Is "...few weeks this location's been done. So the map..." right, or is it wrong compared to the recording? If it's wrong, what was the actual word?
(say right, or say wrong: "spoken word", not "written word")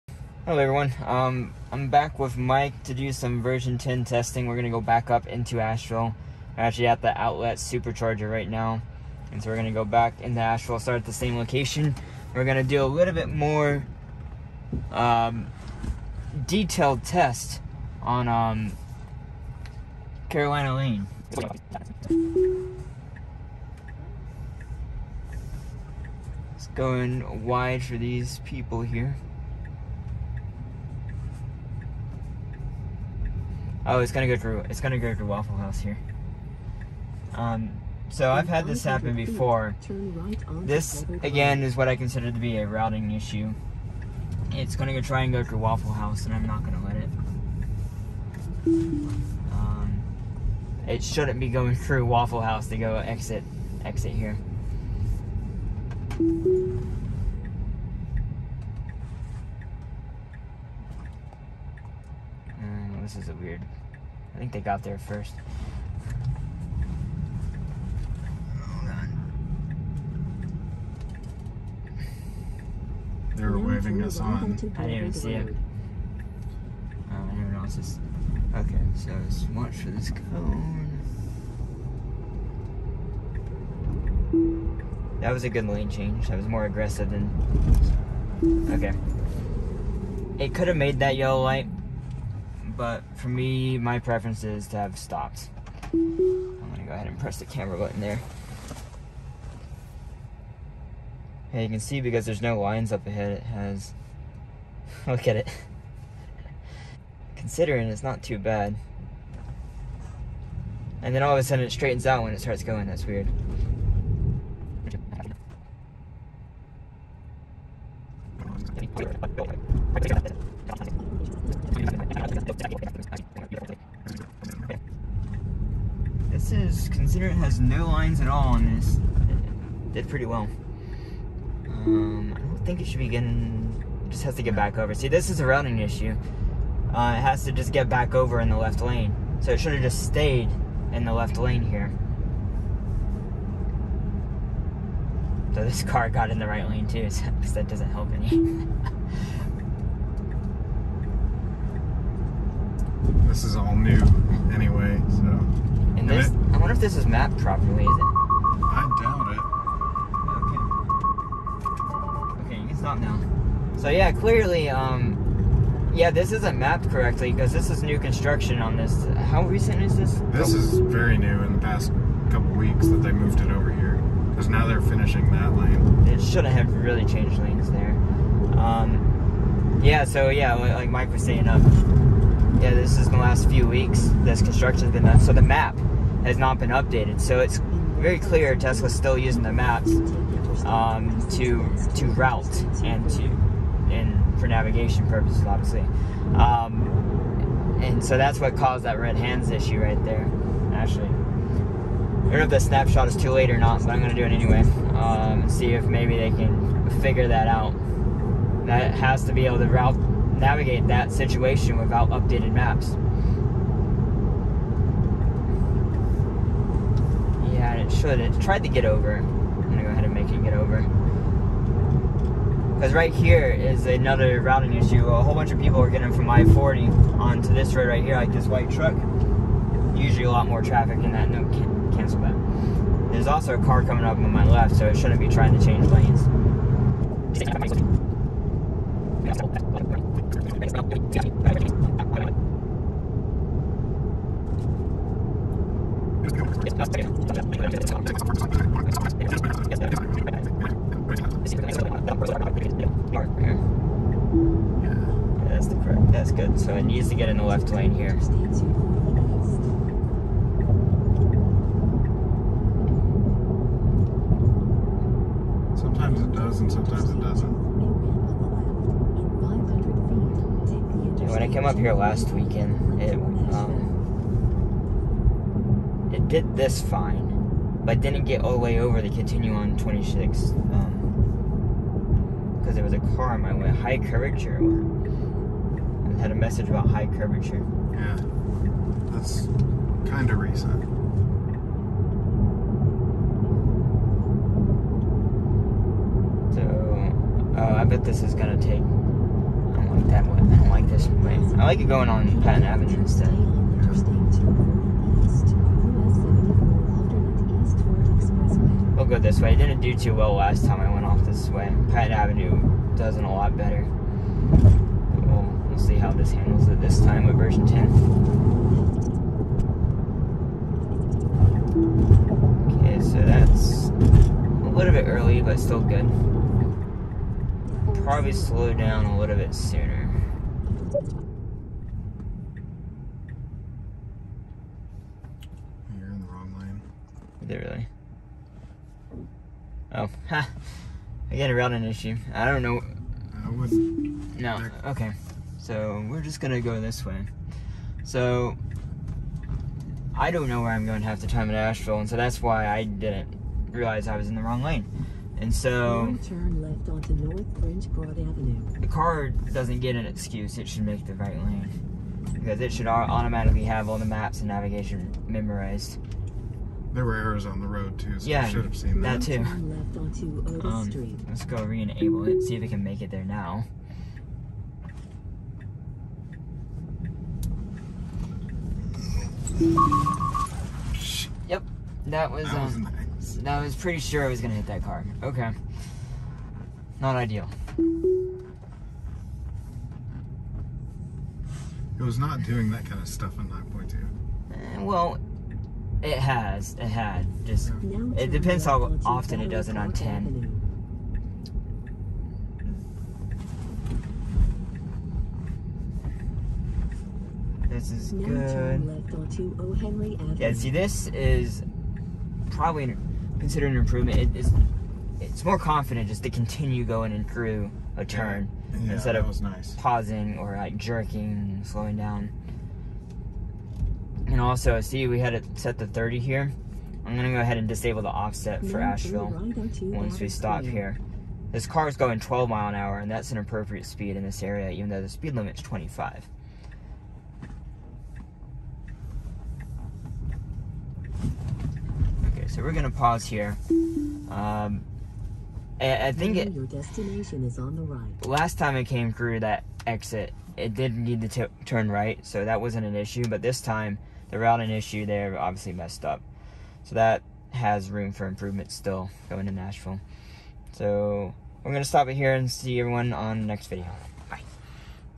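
wrong: "construction", not "location".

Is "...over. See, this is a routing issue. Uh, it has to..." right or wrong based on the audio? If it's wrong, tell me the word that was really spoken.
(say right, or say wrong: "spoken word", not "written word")
right.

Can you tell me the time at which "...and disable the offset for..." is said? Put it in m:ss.
7:07.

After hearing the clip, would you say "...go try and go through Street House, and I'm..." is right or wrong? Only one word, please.
wrong.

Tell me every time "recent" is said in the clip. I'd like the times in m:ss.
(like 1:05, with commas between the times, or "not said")
2:49, 4:50.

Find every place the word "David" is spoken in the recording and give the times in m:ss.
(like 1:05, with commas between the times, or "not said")
not said.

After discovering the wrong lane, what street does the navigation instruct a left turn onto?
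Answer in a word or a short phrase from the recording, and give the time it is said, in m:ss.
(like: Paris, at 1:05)
North French Broad Avenue, at 5:57.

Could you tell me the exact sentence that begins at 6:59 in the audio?
pausing or like jerking, slowing down.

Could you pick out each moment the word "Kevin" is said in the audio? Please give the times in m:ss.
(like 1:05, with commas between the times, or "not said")
not said.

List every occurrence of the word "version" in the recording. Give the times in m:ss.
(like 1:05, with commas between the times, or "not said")
0:03, 5:17.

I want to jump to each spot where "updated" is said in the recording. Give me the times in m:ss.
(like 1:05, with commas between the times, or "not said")
3:06, 3:32.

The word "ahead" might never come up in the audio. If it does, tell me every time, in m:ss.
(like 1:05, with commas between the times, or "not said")
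1:36, 1:43, 3:39, 7:07.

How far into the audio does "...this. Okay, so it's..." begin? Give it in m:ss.
1:17.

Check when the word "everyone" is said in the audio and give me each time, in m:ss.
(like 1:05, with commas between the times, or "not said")
0:00, 7:42.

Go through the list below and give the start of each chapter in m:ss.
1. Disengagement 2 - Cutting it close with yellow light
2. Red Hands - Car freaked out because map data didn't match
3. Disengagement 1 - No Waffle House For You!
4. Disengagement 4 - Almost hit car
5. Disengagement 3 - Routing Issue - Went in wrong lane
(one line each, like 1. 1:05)
1. 1:27
2. 2:33
3. 0:45
4. 6:17
5. 5:36.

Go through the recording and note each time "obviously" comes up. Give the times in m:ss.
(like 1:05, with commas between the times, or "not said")
3:15, 7:35.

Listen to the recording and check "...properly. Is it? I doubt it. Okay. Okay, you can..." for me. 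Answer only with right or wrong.
right.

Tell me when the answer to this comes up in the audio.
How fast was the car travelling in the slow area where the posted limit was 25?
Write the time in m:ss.
7:12.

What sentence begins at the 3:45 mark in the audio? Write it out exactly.
A whole bunch of people are getting from I-40 onto this road right here, like this white truck.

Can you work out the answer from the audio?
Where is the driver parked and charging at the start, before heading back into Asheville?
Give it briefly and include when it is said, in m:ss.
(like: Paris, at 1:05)
Outlet supercharger, at 0:07.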